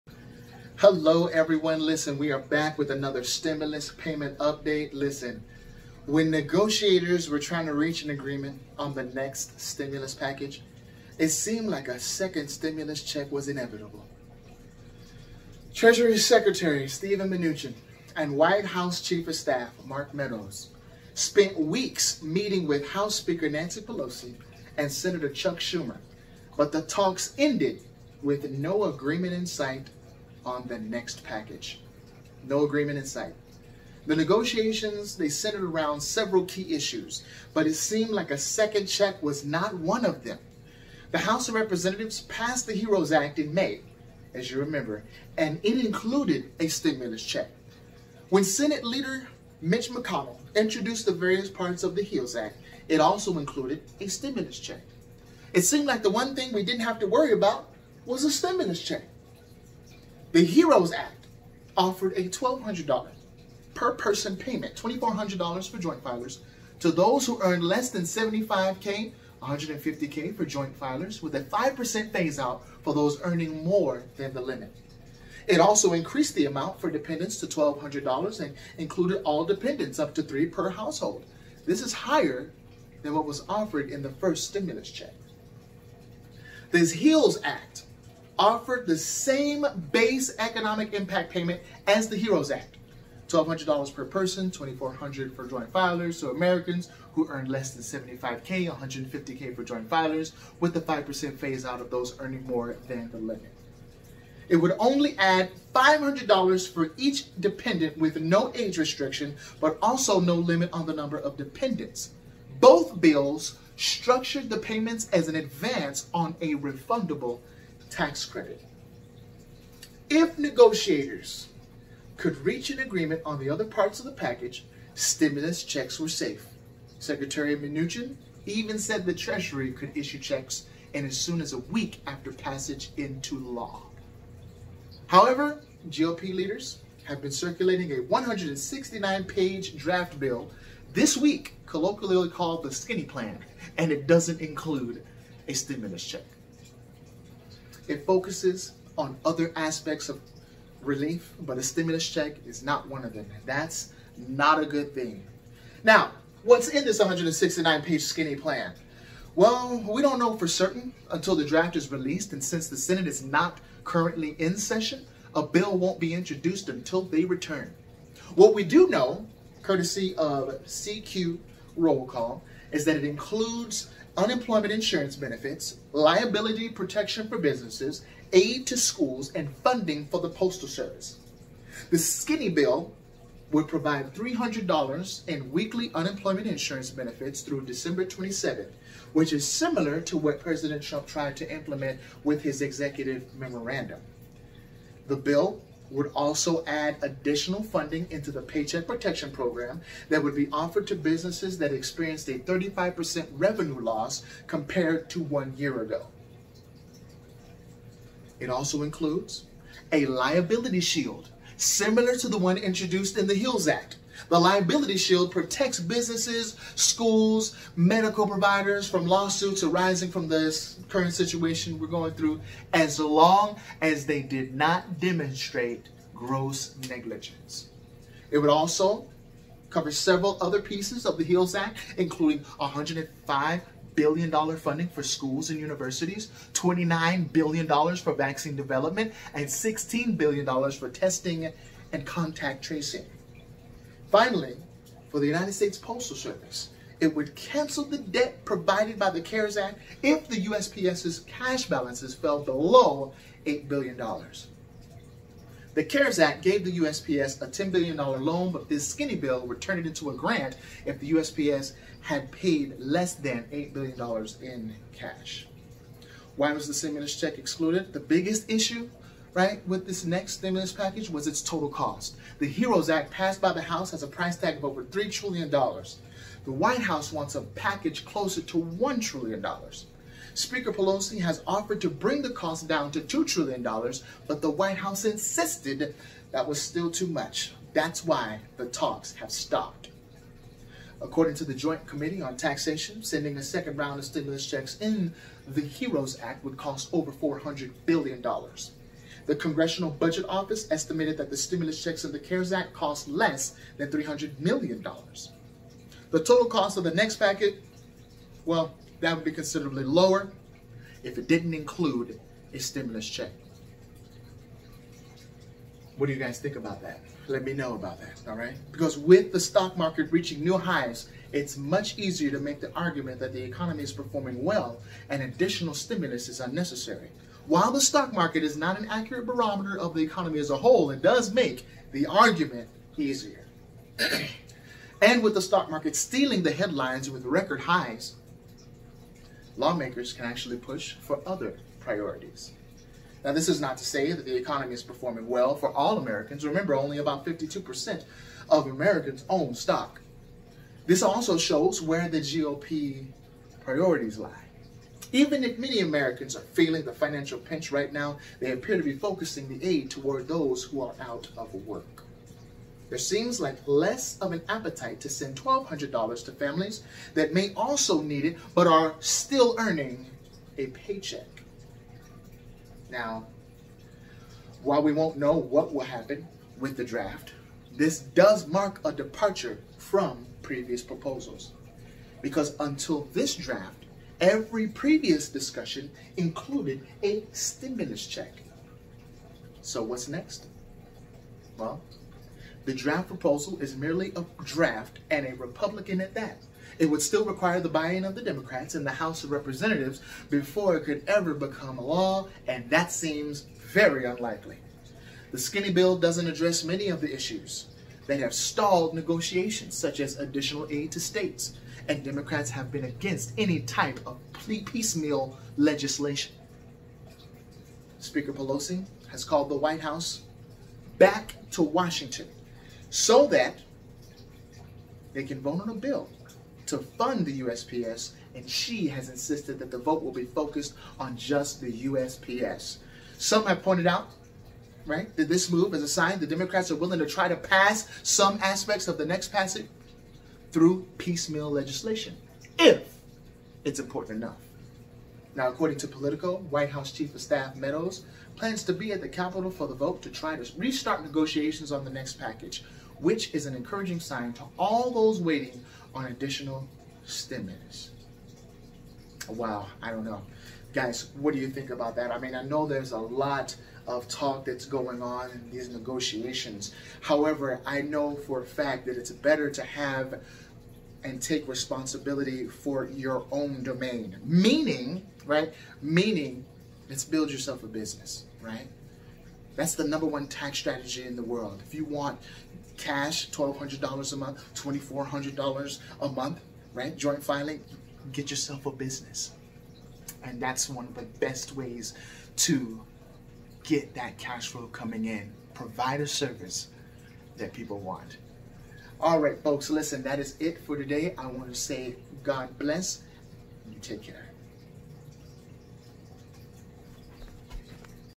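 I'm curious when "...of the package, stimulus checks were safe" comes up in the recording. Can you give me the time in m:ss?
2:03.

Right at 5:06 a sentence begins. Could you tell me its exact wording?
The total cost of the next packet, well, that would be considerably lower if it didn't include a stimulus check.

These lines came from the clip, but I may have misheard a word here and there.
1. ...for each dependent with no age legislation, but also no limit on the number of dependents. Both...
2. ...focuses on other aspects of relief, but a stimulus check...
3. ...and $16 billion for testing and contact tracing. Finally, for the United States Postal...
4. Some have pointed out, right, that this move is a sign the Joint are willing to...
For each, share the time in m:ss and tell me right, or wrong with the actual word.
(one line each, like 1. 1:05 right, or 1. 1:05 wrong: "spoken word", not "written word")
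1. 1:46 wrong: "restriction", not "legislation"
2. 2:28 right
3. 3:59 right
4. 7:13 wrong: "Democrats", not "Joint".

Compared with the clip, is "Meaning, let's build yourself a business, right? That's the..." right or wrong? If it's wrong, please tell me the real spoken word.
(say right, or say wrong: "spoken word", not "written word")
right.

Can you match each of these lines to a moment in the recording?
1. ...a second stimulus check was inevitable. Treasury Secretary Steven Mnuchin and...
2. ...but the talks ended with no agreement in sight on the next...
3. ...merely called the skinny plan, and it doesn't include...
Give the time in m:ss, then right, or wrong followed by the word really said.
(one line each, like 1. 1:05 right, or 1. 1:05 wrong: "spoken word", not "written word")
1. 0:11 right
2. 0:26 right
3. 2:21 wrong: "colloquially", not "merely".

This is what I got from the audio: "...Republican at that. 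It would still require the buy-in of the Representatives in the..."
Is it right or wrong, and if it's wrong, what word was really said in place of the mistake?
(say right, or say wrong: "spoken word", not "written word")
wrong: "Democrats", not "Representatives".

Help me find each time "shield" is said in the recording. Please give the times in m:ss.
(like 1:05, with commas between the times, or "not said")
3:30, 3:34.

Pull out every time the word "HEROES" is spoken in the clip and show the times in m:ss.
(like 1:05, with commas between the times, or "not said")
0:42, 0:52, 1:00, 1:32, 4:32, 4:55.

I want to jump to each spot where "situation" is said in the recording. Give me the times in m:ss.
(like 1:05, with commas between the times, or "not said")
3:41.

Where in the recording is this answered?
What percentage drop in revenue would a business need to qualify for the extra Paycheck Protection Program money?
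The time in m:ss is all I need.
3:22.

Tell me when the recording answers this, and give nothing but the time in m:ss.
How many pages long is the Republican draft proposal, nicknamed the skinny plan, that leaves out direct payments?
2:17.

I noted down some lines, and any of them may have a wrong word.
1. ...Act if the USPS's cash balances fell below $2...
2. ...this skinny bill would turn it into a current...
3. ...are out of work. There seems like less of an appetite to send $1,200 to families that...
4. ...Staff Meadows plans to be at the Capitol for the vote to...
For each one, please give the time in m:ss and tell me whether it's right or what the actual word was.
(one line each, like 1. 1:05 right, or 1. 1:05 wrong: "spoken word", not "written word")
1. 4:09 wrong: "8", not "2"
2. 4:18 wrong: "grant", not "current"
3. 6:00 right
4. 7:27 right.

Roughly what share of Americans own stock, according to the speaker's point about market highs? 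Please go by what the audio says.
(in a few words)
52%.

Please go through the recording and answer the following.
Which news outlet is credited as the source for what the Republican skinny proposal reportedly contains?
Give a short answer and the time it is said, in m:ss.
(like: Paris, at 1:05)
CQ Roll Call, at 2:50.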